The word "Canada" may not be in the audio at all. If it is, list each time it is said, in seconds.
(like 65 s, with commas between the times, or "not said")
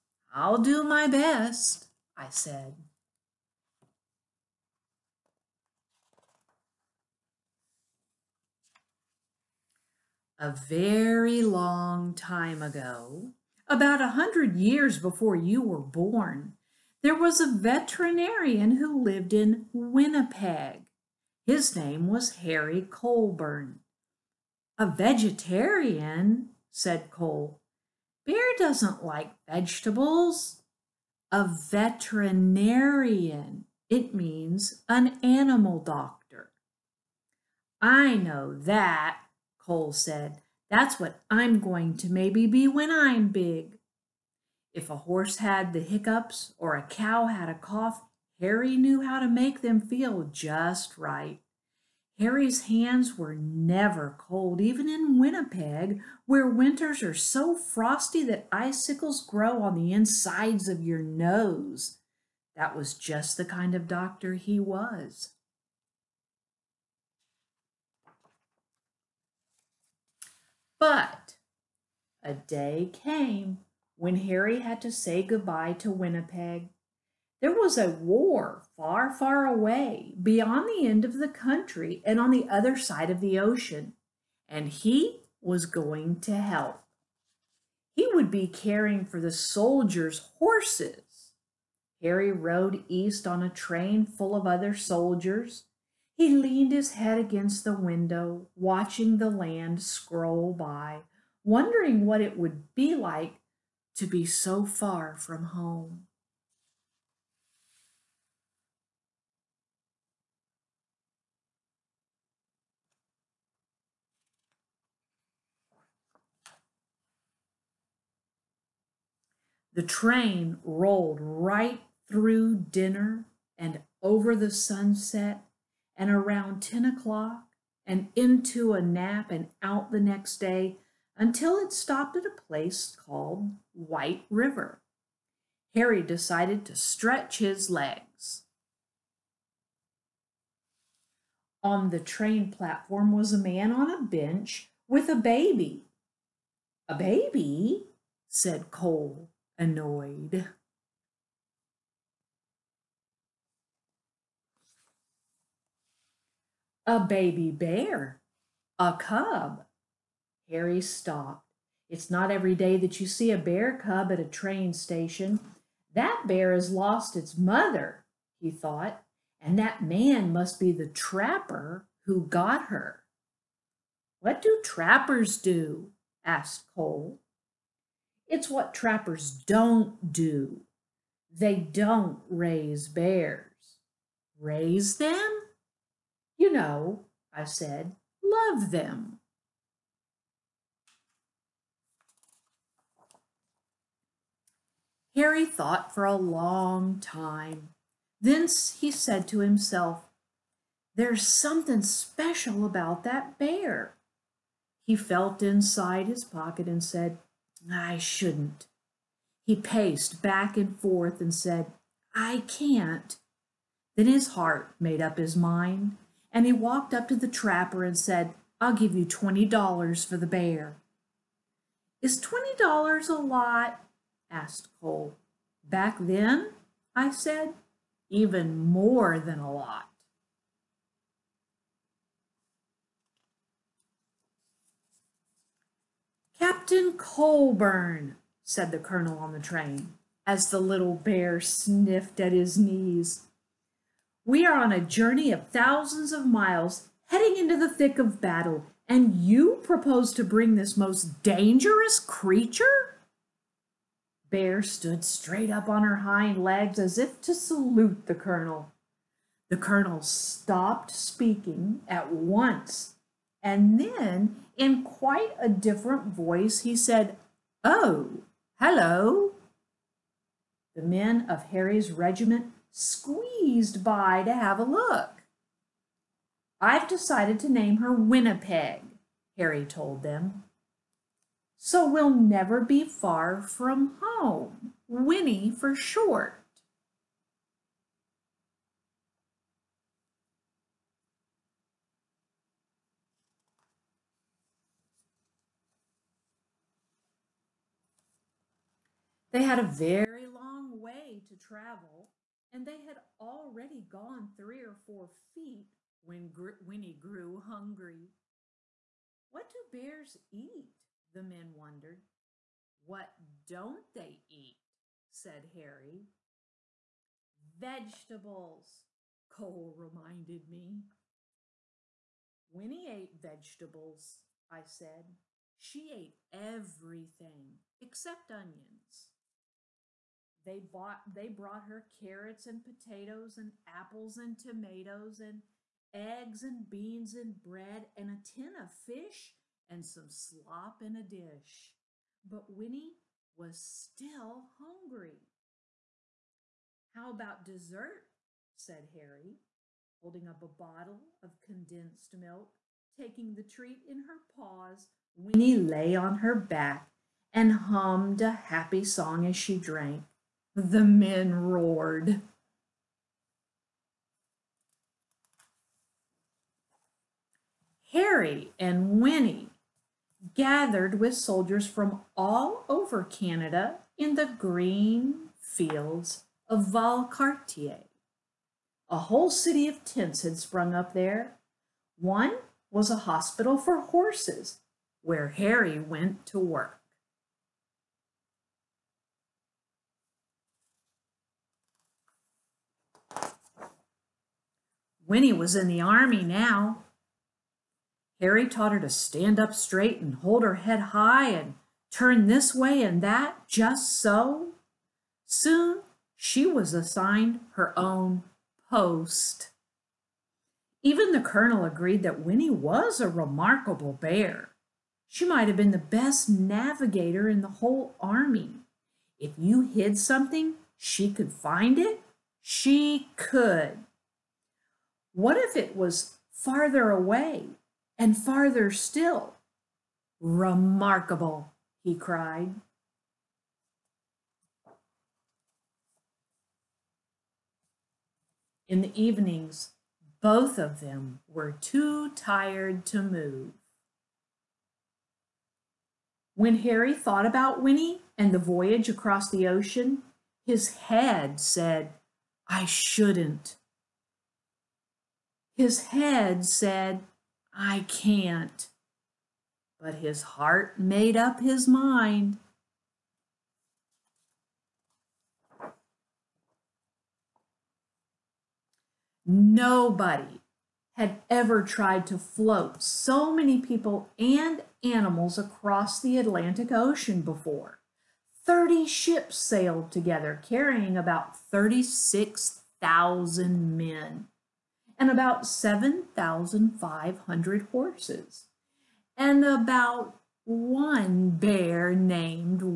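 373 s.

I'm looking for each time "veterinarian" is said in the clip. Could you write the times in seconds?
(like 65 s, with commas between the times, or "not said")
17 s, 31 s.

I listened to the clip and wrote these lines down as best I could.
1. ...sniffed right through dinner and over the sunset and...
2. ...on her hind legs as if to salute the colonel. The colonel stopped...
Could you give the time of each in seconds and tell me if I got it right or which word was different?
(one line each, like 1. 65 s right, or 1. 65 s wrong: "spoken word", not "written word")
1. 120 s wrong: "rolled", not "sniffed"
2. 255 s right.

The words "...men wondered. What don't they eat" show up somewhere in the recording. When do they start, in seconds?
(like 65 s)
311 s.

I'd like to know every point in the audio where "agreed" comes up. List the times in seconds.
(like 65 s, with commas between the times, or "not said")
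411 s.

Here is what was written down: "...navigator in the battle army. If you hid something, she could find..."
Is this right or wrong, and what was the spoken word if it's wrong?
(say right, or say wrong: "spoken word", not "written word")
wrong: "whole", not "battle".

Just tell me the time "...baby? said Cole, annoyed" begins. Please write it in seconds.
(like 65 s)
146 s.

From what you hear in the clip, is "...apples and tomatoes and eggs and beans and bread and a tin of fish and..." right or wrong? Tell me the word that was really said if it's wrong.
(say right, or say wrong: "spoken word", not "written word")
right.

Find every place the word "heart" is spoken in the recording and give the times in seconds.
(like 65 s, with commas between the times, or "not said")
214 s, 460 s.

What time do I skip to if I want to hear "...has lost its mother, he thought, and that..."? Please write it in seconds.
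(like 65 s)
166 s.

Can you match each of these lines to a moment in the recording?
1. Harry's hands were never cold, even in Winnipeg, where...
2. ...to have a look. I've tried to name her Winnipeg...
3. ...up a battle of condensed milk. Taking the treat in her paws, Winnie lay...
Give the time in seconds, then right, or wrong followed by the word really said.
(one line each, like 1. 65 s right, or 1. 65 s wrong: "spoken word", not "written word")
1. 52 s right
2. 274 s wrong: "decided", not "tried"
3. 350 s wrong: "bottle", not "battle".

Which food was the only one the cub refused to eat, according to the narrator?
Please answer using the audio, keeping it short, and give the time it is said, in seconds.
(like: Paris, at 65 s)
Onions, at 328 s.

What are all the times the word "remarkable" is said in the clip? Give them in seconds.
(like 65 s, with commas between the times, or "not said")
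413 s, 430 s.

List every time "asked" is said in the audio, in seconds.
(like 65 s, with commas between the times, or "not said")
176 s, 224 s.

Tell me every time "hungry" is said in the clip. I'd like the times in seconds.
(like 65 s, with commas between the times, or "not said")
307 s, 344 s.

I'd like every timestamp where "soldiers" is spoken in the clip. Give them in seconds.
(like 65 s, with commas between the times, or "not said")
89 s, 94 s, 371 s.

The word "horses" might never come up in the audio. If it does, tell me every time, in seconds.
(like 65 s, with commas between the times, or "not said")
44 s, 90 s, 383 s, 487 s.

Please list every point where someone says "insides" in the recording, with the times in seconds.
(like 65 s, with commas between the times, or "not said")
59 s, 205 s.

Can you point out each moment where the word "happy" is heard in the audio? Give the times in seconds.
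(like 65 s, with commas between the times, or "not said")
358 s.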